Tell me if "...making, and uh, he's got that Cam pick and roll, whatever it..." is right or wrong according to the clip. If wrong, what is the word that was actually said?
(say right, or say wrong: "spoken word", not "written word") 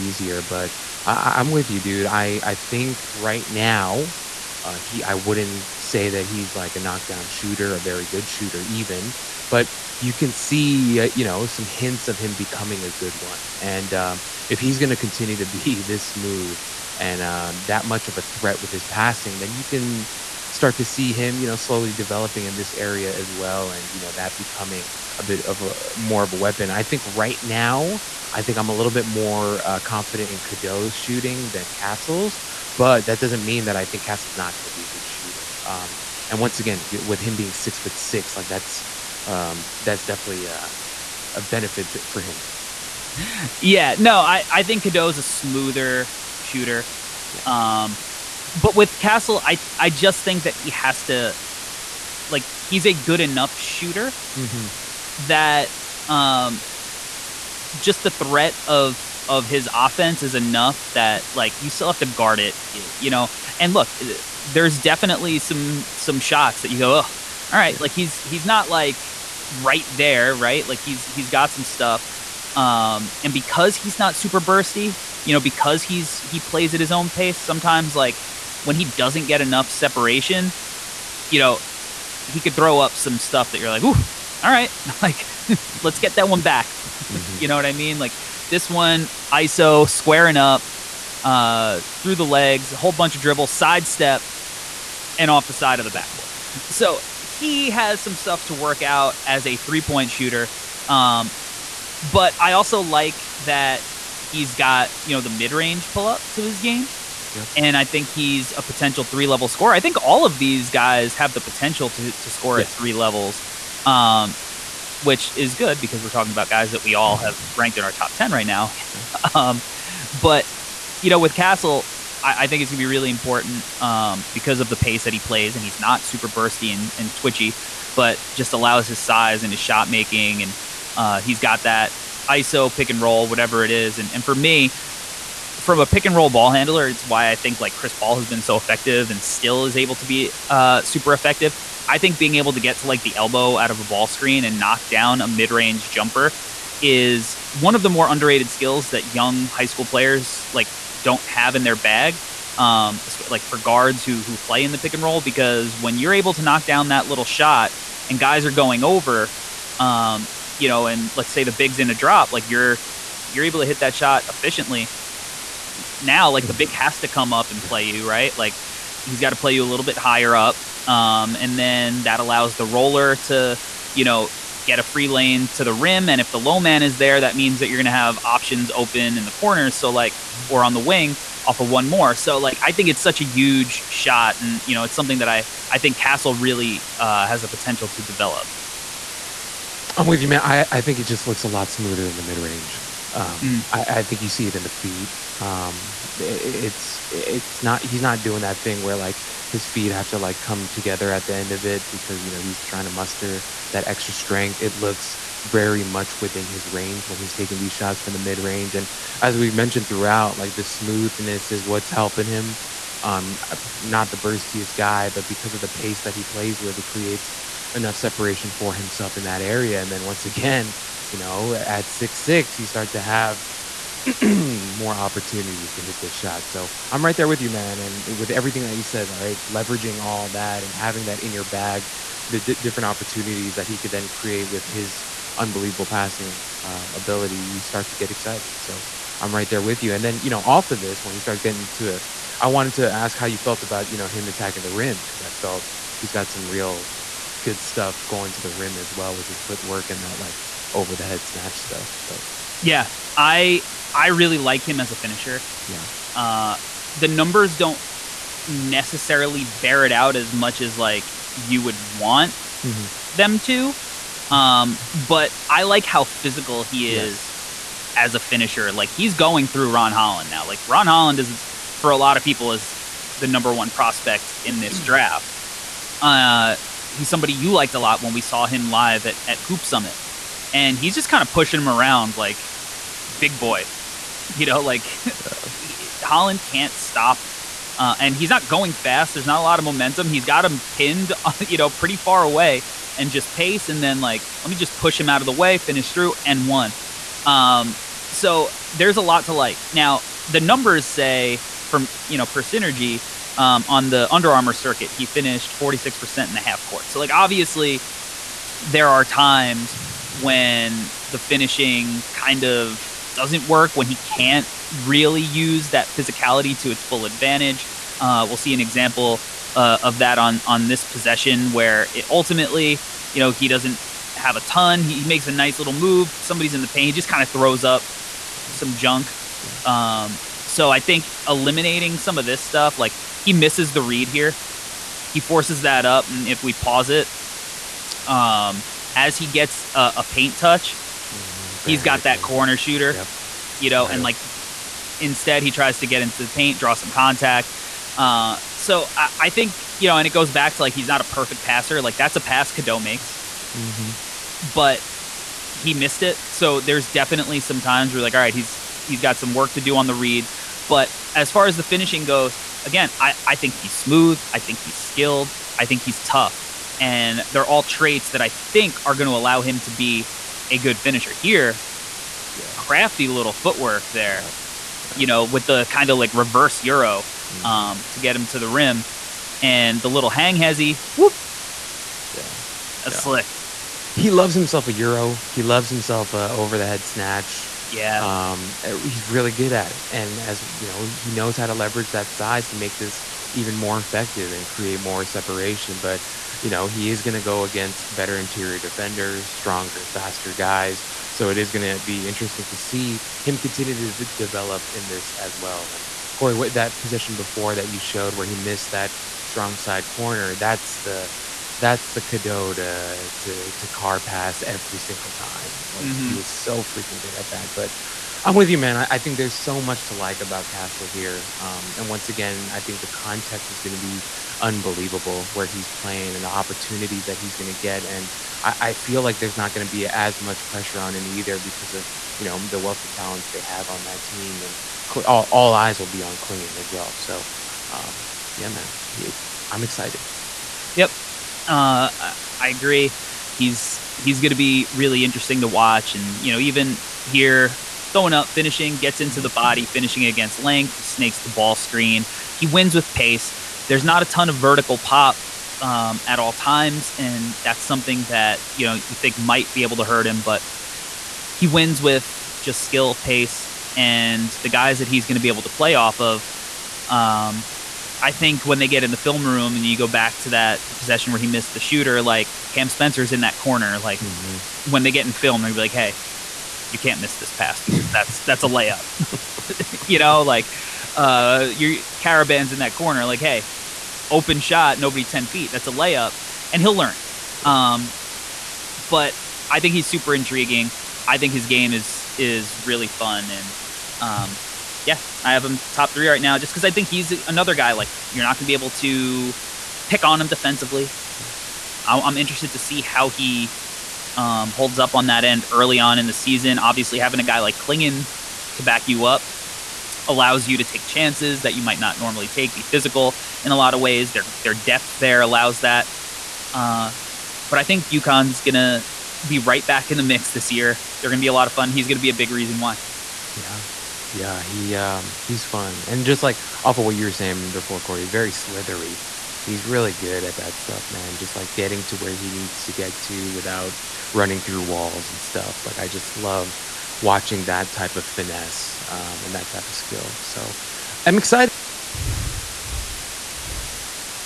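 wrong: "ISO", not "Cam".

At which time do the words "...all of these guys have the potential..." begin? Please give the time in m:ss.
1:50.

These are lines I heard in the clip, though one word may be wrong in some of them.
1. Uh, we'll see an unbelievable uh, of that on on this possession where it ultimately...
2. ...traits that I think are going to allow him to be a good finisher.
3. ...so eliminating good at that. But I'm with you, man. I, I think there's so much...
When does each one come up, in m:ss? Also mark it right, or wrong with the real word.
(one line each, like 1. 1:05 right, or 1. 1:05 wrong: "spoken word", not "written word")
1. 5:17 wrong: "example", not "unbelievable"
2. 6:07 right
3. 6:56 wrong: "freaking", not "eliminating".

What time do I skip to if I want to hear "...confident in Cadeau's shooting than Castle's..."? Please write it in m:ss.
0:29.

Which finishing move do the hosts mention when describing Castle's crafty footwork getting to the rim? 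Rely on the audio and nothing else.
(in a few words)
reverse euro.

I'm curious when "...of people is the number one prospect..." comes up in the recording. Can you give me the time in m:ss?
4:32.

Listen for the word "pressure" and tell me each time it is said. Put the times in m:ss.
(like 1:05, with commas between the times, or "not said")
7:10.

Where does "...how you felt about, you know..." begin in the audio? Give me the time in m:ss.
4:03.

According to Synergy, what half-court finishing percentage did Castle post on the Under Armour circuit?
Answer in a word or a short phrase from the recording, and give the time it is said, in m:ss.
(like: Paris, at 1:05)
46%, at 5:05.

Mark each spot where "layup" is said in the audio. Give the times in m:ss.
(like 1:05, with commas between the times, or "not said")
7:58, 8:05.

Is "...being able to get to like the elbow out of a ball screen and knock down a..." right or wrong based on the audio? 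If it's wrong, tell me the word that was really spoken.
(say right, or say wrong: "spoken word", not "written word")
right.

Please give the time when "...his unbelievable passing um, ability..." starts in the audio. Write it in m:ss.
3:54.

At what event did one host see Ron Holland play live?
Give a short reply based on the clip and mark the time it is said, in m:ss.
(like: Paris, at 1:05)
Hoop Summit, at 4:39.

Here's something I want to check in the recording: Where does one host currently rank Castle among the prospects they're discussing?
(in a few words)
top 3.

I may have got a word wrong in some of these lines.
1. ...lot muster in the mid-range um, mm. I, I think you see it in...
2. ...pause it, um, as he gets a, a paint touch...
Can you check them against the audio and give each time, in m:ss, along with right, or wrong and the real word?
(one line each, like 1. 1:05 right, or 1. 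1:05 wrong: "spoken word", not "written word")
1. 3:11 wrong: "smoother", not "muster"
2. 5:36 right.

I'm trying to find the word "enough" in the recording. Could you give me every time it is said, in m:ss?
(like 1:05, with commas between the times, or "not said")
0:53, 1:00, 1:19, 3:37.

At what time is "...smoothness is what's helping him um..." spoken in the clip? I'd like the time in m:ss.
3:30.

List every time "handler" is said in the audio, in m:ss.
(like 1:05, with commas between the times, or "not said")
2:16.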